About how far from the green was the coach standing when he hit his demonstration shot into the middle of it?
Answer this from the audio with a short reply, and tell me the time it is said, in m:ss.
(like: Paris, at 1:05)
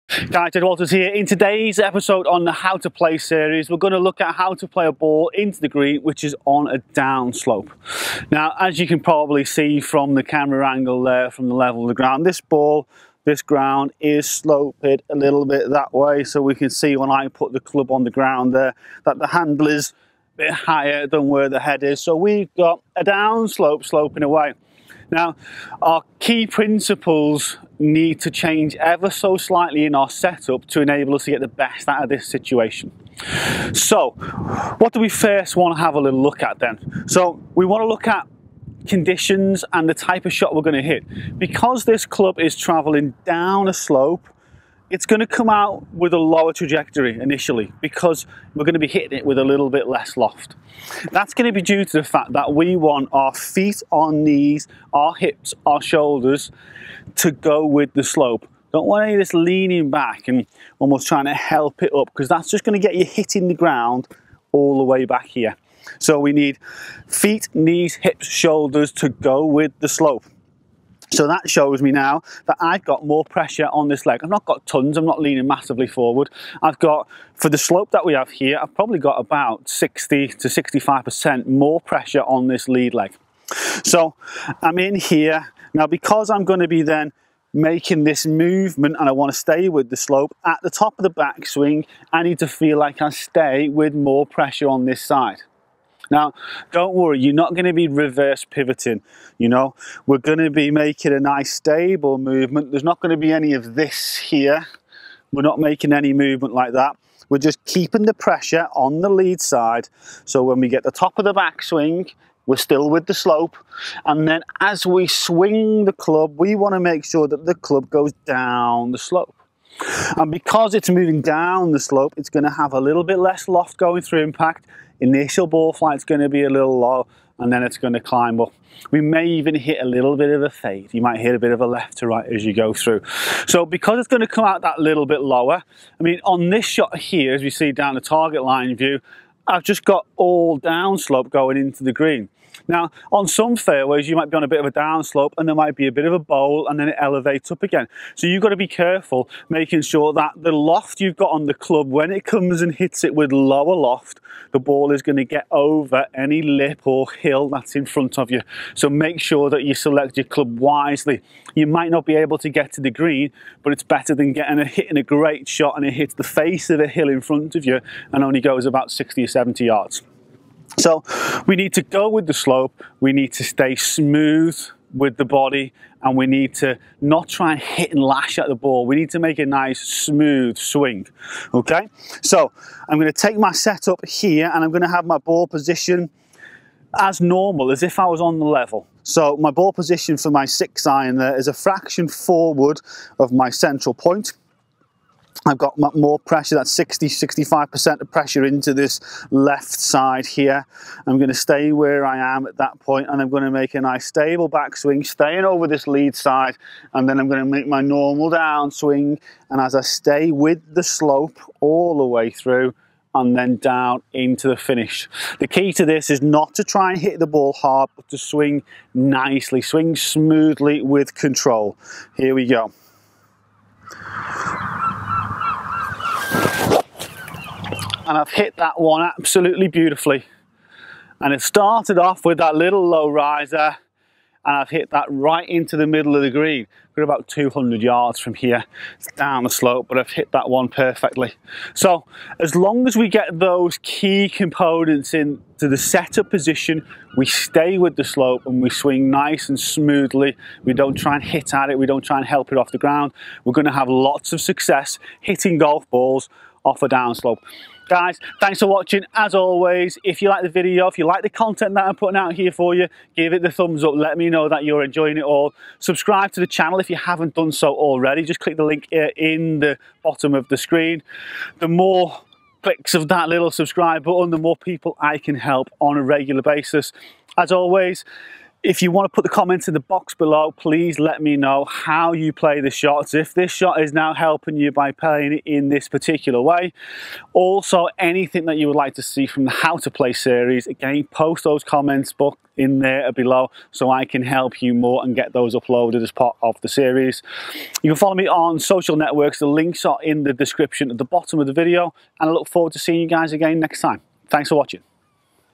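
200 yards, at 3:57.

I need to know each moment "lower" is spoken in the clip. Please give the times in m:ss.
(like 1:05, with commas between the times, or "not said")
0:46, 2:15, 2:33.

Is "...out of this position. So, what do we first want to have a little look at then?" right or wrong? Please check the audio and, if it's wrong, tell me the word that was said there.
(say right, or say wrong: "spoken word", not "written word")
wrong: "situation", not "position".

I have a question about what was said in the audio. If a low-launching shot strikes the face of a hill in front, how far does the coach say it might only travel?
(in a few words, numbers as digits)
60 or 70 yards.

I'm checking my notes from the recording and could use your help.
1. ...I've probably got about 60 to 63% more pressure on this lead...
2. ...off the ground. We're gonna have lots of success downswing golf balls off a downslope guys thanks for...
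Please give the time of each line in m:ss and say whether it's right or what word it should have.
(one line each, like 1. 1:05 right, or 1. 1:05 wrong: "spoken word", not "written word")
1. 1:18 wrong: "65", not "63"
2. 4:12 wrong: "hitting", not "downswing".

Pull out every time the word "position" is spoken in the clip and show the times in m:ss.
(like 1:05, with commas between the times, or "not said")
3:05, 3:09, 4:06.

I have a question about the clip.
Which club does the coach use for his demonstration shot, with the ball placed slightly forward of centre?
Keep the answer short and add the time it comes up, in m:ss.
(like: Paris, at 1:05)
Six iron, at 3:10.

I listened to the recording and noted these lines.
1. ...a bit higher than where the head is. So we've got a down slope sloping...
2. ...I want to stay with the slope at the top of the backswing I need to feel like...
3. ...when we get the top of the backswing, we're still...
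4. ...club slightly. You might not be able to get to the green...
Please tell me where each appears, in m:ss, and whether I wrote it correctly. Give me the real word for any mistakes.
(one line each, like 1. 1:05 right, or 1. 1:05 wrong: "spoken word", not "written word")
1. 0:20 right
2. 1:29 right
3. 1:50 right
4. 2:40 wrong: "wisely", not "slightly".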